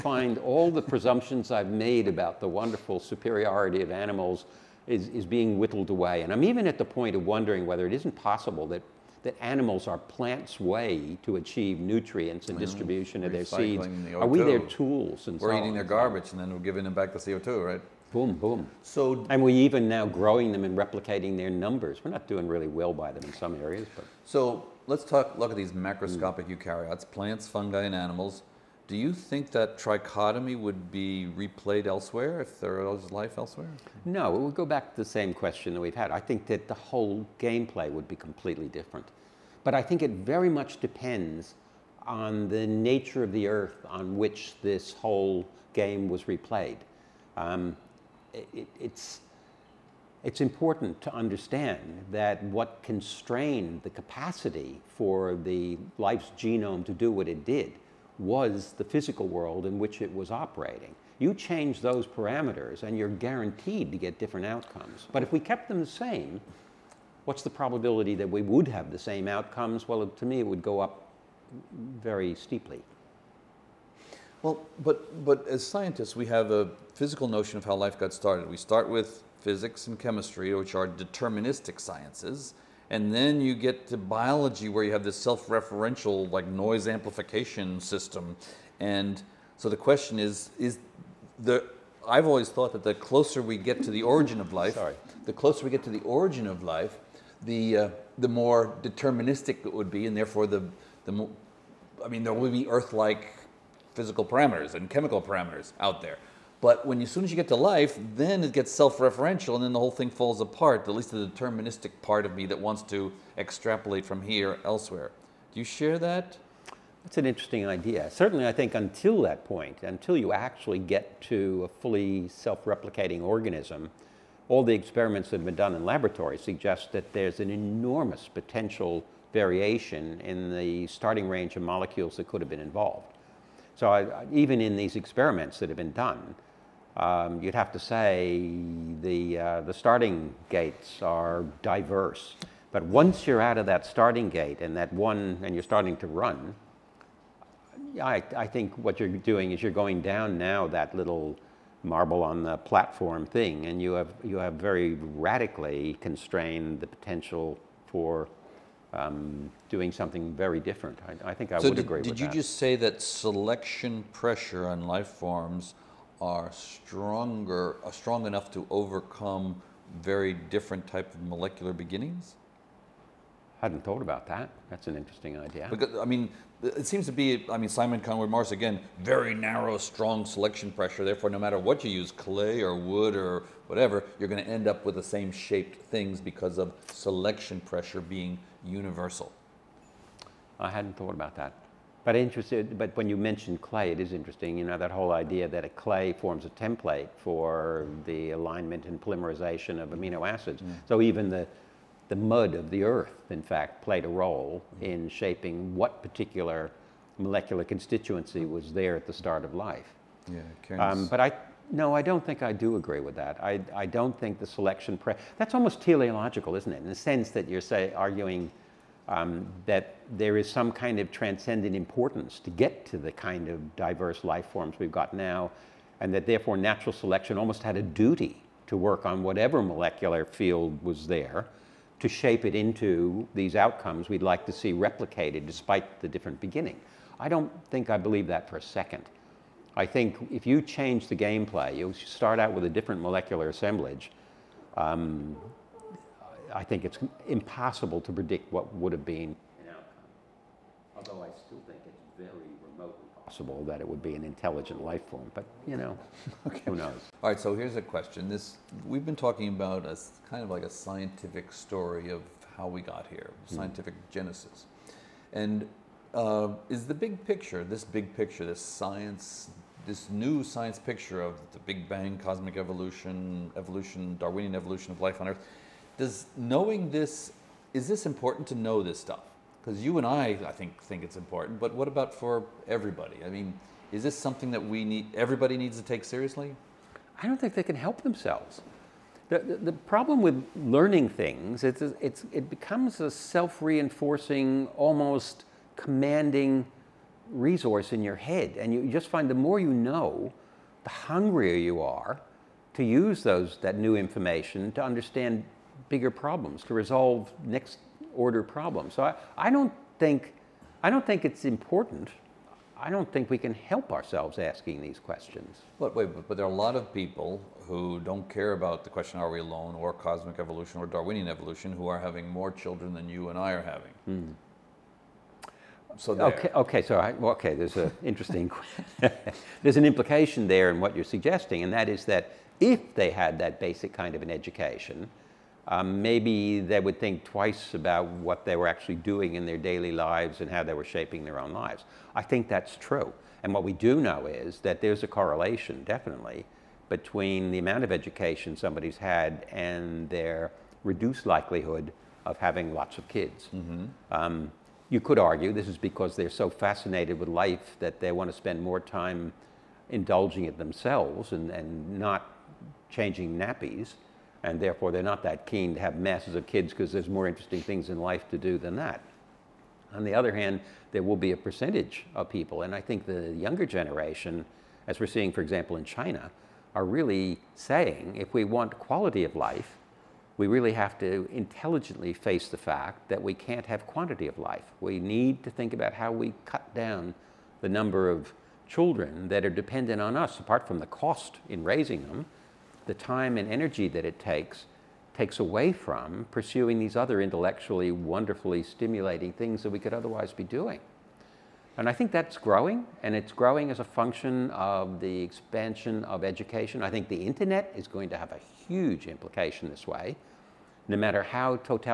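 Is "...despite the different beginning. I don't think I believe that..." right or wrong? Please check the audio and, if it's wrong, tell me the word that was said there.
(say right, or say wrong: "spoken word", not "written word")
right.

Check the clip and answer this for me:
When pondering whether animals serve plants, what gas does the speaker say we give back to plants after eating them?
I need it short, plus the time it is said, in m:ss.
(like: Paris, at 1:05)
CO2, at 0:17.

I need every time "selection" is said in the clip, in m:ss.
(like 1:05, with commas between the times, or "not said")
2:43, 3:00, 3:06, 3:34, 3:46.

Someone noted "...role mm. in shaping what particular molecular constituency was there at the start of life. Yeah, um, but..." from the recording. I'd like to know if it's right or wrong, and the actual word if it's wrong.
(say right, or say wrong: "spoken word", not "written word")
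right.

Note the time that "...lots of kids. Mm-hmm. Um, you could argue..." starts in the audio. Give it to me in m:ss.
5:52.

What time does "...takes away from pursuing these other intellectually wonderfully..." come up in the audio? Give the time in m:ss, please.
6:35.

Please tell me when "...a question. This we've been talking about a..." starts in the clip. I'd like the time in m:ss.
4:17.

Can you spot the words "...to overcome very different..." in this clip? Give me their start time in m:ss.
2:48.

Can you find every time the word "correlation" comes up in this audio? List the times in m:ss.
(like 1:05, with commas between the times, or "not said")
5:45.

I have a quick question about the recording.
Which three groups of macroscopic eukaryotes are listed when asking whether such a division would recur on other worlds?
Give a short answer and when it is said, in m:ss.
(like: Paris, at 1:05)
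plants, fungi, and animals, at 0:27.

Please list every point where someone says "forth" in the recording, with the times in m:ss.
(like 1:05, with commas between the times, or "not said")
not said.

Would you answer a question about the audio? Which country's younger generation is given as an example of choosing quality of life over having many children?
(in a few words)
China.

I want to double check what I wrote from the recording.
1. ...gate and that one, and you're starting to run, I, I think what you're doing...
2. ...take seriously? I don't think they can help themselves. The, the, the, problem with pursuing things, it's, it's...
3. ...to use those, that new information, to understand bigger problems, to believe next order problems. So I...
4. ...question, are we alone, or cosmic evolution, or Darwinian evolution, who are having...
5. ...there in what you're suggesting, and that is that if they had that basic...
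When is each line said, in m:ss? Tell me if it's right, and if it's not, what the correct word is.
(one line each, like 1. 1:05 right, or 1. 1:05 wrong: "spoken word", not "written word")
1. 2:24 right
2. 4:45 wrong: "learning", not "pursuing"
3. 5:02 wrong: "resolve", not "believe"
4. 5:18 right
5. 5:30 right.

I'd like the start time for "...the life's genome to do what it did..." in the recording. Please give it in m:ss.
0:55.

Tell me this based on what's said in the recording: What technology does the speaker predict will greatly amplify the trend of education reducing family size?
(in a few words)
the internet.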